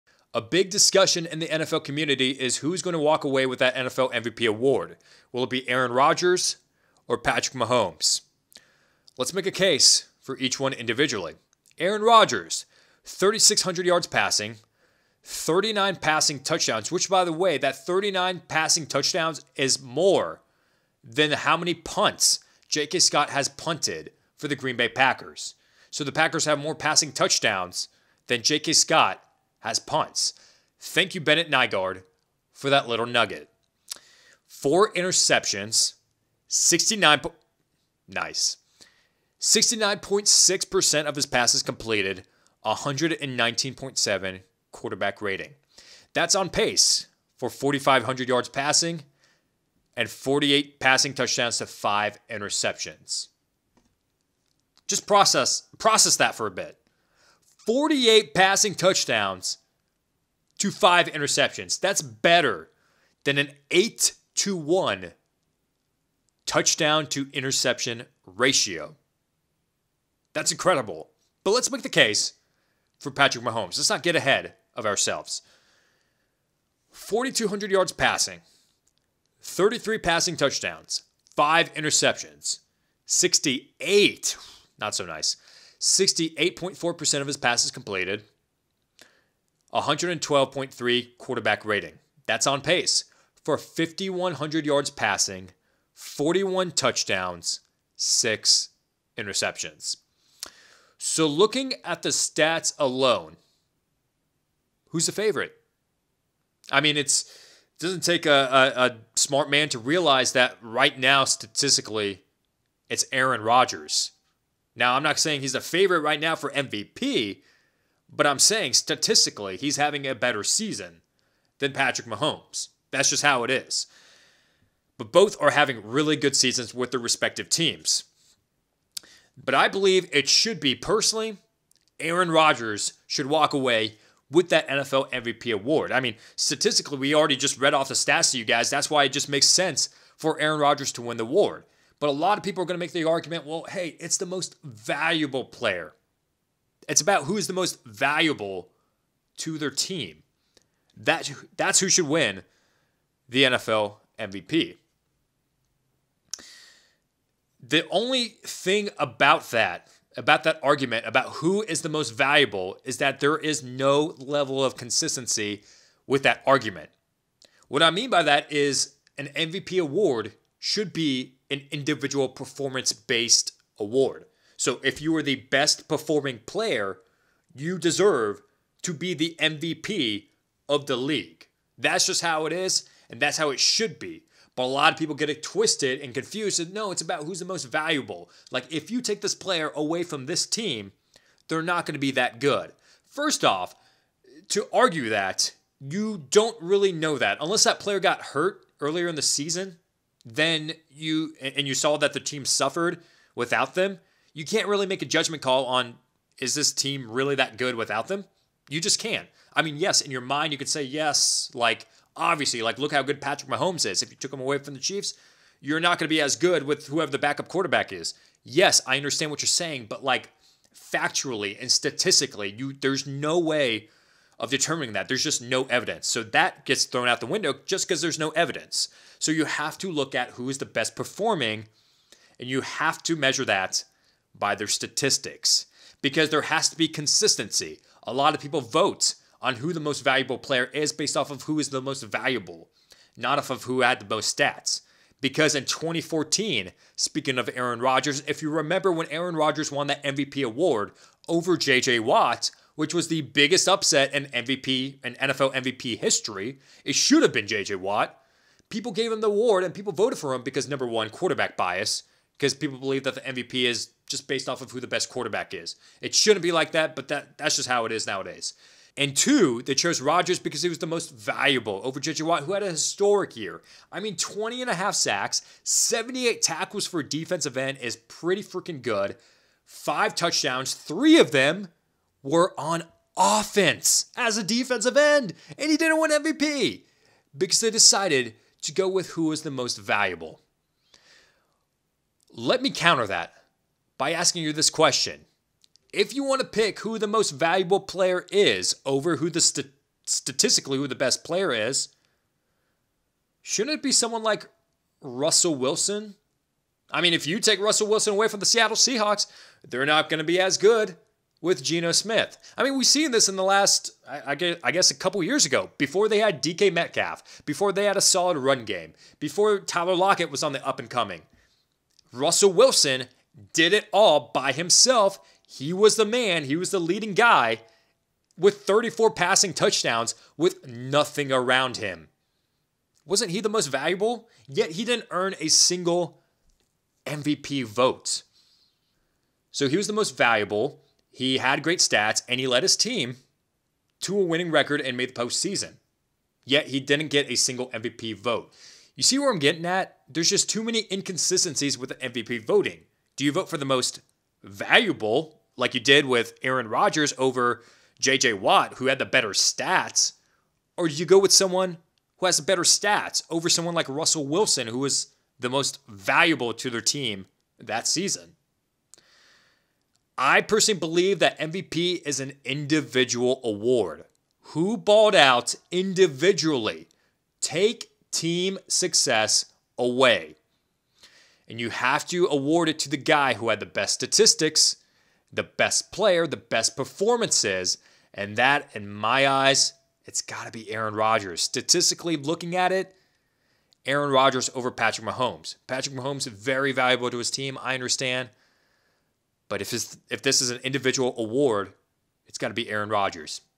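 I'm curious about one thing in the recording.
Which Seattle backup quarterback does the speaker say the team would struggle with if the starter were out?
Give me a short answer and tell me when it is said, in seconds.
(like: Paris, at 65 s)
Geno Smith, at 311 s.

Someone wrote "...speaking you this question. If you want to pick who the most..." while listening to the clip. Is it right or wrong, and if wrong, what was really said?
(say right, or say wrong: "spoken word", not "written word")
wrong: "asking", not "speaking".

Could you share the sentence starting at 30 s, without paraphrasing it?
Thank you, Bennett Nygard, for that little nugget.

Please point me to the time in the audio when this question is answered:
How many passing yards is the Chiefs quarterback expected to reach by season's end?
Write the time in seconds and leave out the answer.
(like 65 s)
93 s.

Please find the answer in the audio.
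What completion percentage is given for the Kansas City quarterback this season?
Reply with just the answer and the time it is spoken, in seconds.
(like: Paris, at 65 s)
68.4%, at 85 s.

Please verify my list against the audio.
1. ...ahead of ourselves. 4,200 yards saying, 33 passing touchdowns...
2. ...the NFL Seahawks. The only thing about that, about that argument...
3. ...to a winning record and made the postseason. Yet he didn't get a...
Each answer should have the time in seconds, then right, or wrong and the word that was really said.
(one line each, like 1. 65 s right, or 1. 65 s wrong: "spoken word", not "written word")
1. 74 s wrong: "passing", not "saying"
2. 153 s wrong: "MVP", not "Seahawks"
3. 344 s right.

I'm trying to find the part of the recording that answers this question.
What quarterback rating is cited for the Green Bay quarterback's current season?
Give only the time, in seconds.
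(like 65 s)
42 s.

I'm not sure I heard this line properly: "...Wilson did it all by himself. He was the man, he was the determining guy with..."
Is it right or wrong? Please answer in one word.
wrong.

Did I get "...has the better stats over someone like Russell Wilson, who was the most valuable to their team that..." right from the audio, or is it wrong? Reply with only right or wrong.
right.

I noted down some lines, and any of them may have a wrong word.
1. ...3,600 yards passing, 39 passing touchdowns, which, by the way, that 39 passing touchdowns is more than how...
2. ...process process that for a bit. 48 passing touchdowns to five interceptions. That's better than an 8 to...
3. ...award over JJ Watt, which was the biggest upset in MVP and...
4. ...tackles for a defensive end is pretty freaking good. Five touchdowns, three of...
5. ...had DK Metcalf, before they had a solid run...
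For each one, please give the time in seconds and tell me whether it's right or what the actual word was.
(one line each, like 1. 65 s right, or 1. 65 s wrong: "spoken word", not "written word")
1. 13 s right
2. 55 s right
3. 250 s right
4. 276 s right
5. 316 s right.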